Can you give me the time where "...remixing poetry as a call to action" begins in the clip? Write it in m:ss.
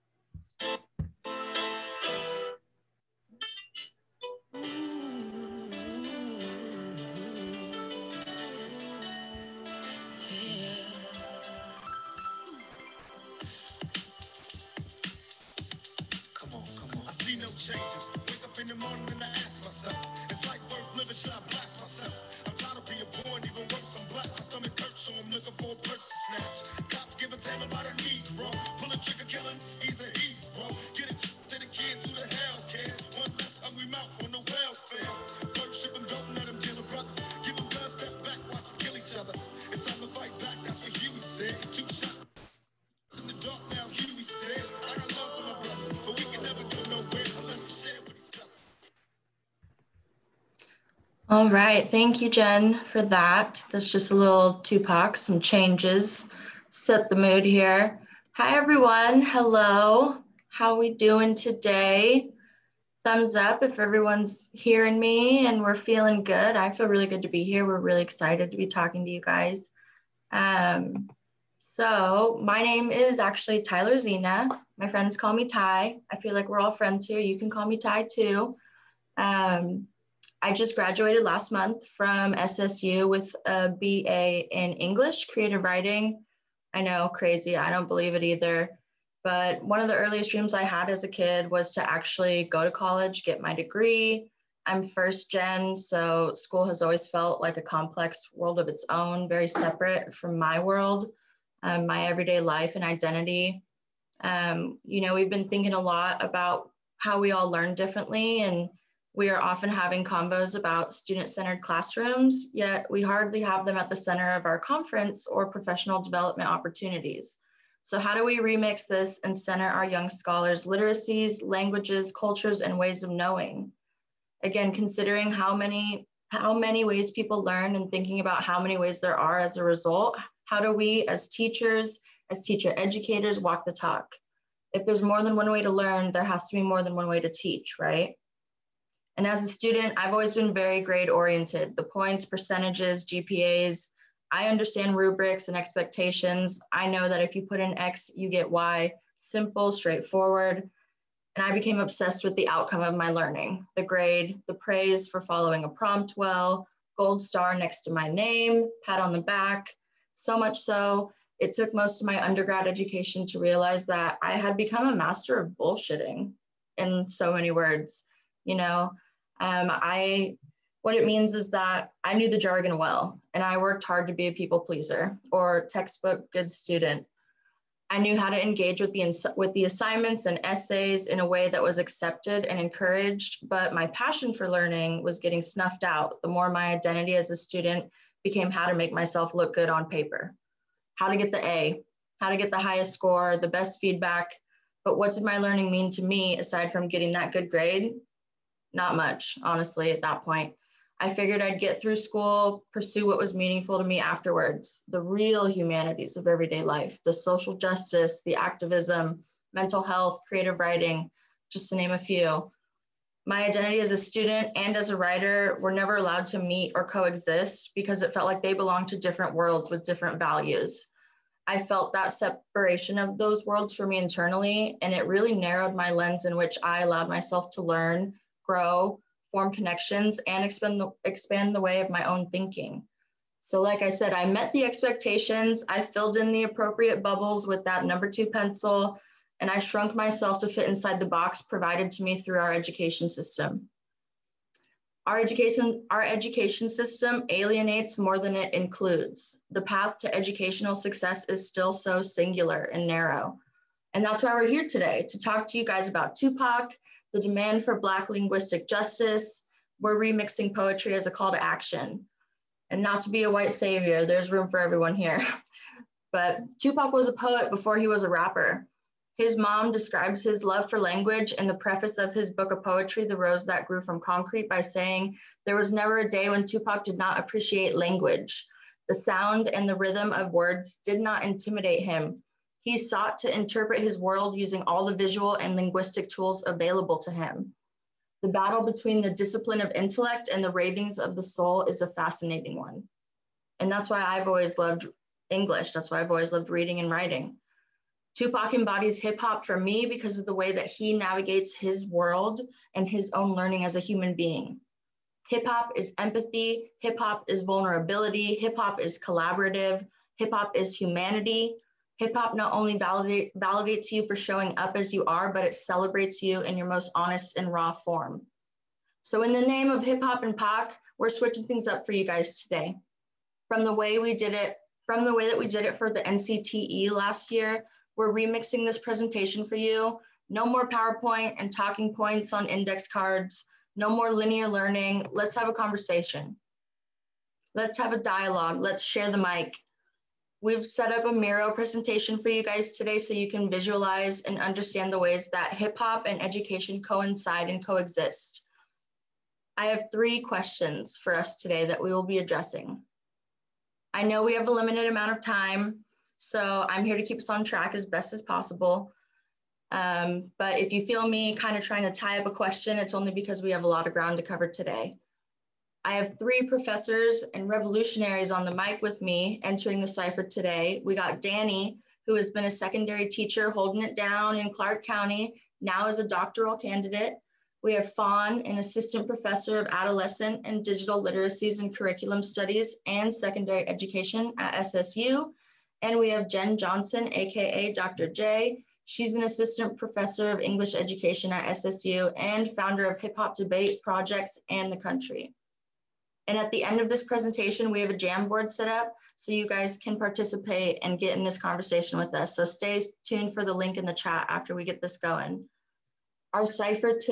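4:19.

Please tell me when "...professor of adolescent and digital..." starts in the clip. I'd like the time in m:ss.
6:19.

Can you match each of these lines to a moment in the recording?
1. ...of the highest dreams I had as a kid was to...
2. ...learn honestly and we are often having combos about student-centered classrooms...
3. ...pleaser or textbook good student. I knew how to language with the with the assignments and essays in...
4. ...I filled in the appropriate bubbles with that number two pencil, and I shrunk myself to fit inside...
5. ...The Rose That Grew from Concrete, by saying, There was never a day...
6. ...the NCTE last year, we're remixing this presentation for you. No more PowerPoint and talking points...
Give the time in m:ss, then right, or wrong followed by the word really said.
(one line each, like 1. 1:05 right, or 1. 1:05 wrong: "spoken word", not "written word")
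1. 1:29 wrong: "earliest", not "highest"
2. 1:47 wrong: "differently", not "honestly"
3. 2:54 wrong: "engage", not "language"
4. 3:55 right
5. 4:33 right
6. 5:25 right.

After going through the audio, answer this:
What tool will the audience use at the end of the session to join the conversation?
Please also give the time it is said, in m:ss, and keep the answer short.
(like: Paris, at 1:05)
Jamboard, at 6:37.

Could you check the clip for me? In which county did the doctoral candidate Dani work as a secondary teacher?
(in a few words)
Clark County.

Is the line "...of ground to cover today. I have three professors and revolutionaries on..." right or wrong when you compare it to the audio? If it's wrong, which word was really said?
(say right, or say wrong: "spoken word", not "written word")
right.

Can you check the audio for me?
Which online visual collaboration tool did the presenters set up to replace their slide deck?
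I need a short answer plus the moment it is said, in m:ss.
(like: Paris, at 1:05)
Miro, at 5:41.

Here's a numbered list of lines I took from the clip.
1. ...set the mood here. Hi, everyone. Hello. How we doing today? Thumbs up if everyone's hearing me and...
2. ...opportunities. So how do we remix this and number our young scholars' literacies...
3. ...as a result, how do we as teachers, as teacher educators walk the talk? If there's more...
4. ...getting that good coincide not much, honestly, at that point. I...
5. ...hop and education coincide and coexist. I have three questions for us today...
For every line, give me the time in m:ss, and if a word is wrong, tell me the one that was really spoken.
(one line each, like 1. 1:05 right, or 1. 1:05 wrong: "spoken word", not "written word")
1. 0:56 right
2. 1:56 wrong: "center", not "number"
3. 2:09 right
4. 3:16 wrong: "grade", not "coincide"
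5. 5:45 right.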